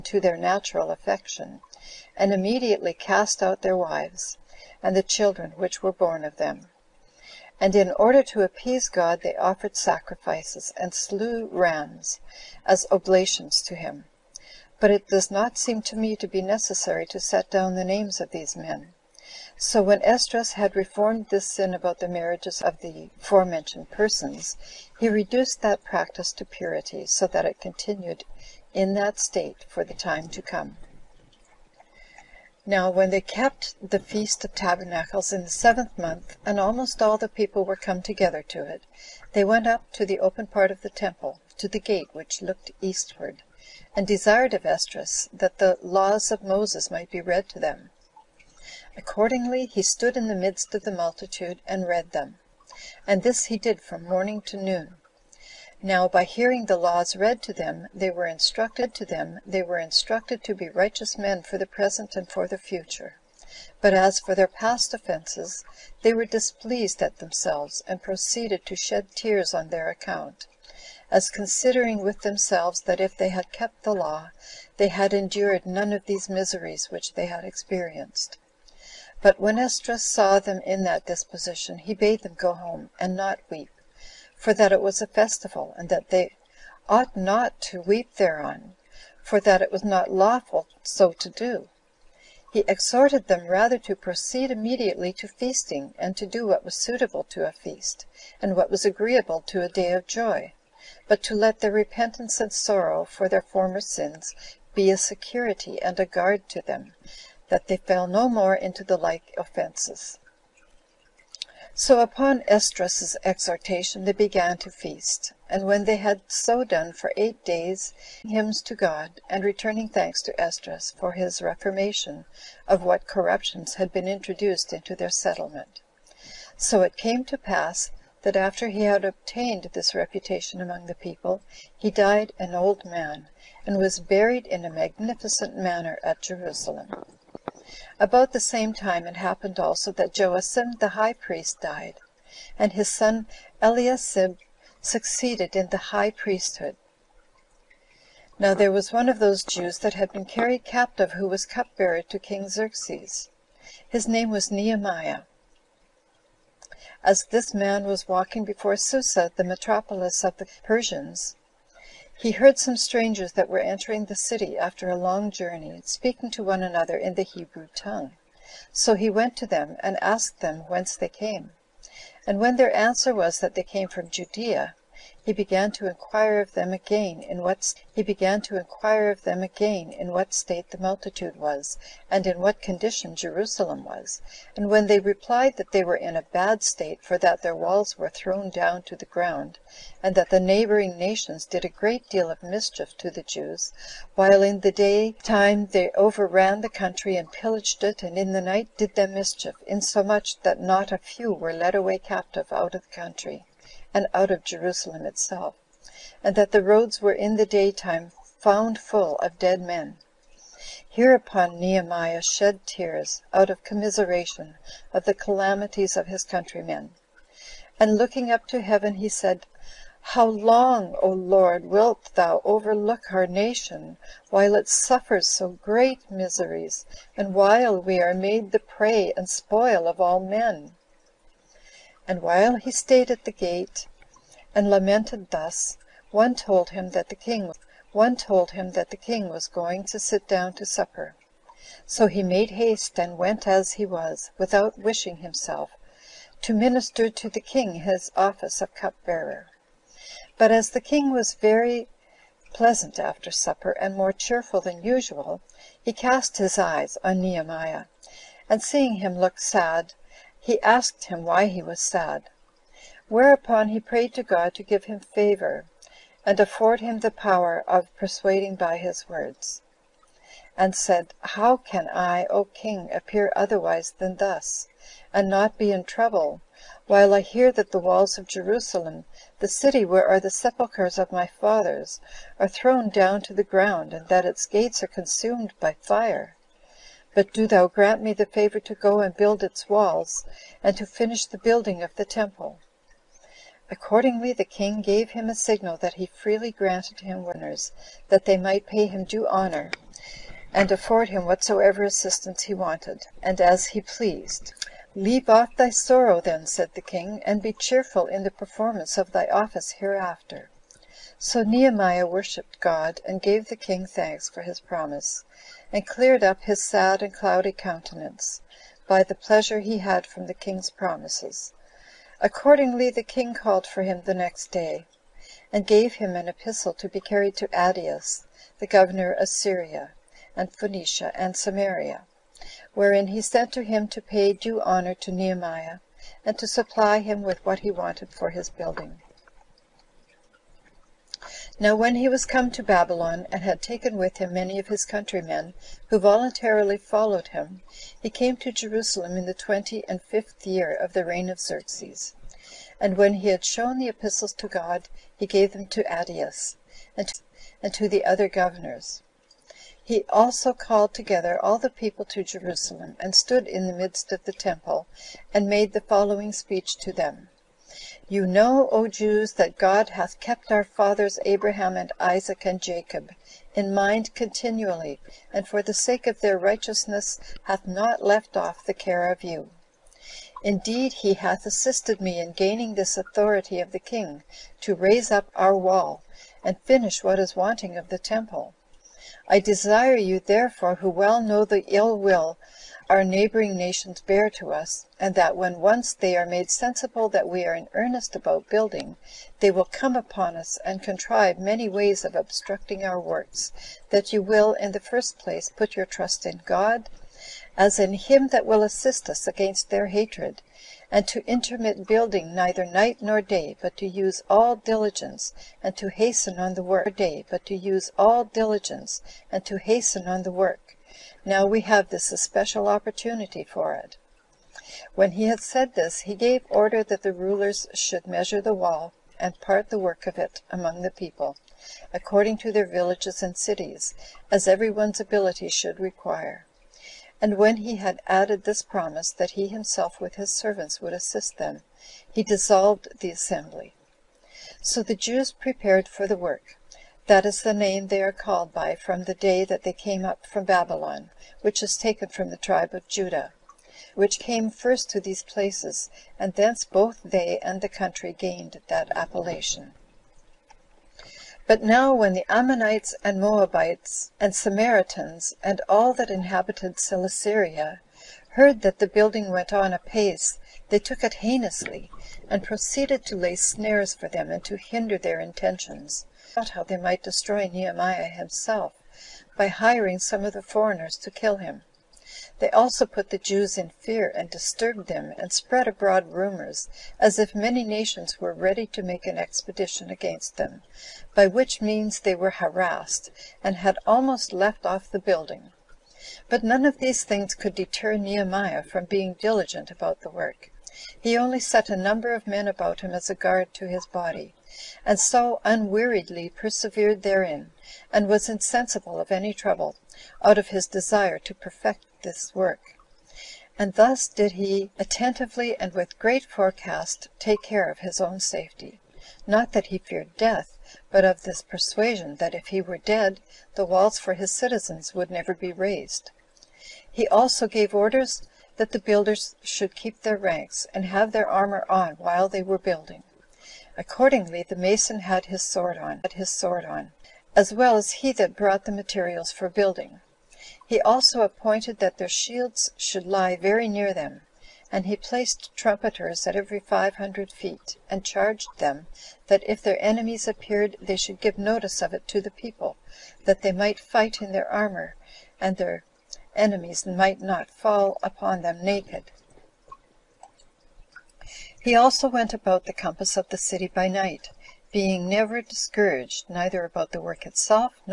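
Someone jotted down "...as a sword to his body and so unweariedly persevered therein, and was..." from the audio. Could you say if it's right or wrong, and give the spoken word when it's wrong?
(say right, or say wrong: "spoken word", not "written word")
wrong: "guard", not "sword".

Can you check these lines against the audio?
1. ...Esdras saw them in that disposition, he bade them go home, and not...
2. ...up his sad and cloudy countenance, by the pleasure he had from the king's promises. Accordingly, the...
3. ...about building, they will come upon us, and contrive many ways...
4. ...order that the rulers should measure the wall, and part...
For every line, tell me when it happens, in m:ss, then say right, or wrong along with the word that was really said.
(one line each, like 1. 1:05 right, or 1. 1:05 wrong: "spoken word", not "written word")
1. 1:19 right
2. 5:16 right
3. 6:38 right
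4. 7:06 right.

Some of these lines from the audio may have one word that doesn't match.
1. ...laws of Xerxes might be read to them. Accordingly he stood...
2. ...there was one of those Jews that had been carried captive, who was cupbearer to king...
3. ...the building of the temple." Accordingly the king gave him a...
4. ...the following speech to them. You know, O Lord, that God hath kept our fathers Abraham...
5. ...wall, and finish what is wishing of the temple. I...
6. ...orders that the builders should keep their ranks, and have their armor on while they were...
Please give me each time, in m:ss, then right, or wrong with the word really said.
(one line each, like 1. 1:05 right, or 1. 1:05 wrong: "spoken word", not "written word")
1. 0:45 wrong: "Moses", not "Xerxes"
2. 2:28 right
3. 4:51 right
4. 6:05 wrong: "Jews", not "Lord"
5. 6:25 wrong: "wanting", not "wishing"
6. 8:47 right.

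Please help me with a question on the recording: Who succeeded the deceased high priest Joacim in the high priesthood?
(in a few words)
Eliasib.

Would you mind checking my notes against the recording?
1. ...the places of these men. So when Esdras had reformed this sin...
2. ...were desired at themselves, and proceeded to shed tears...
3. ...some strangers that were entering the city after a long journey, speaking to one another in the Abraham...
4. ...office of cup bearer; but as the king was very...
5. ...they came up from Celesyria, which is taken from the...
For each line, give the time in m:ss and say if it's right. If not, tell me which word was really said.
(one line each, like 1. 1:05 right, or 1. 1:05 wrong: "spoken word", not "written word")
1. 0:17 wrong: "names", not "places"
2. 1:06 wrong: "displeased", not "desired"
3. 2:42 wrong: "Hebrew", not "Abraham"
4. 4:08 right
5. 7:29 wrong: "Babylon", not "Celesyria".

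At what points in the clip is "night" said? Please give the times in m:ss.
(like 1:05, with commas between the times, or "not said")
3:18, 6:52, 9:23.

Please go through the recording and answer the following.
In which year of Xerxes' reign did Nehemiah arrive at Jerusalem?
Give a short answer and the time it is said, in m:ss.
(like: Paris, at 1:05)
25th, at 5:49.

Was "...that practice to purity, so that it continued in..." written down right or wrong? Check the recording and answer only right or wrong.
right.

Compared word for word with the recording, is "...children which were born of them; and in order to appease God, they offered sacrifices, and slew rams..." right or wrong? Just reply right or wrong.
right.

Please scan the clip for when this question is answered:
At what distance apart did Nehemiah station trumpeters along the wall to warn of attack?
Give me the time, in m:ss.
9:06.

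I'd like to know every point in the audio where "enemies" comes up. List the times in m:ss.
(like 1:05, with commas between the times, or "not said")
9:09, 9:16.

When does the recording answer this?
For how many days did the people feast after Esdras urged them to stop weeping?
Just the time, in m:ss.
1:57.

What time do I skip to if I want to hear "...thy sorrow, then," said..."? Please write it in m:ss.
5:05.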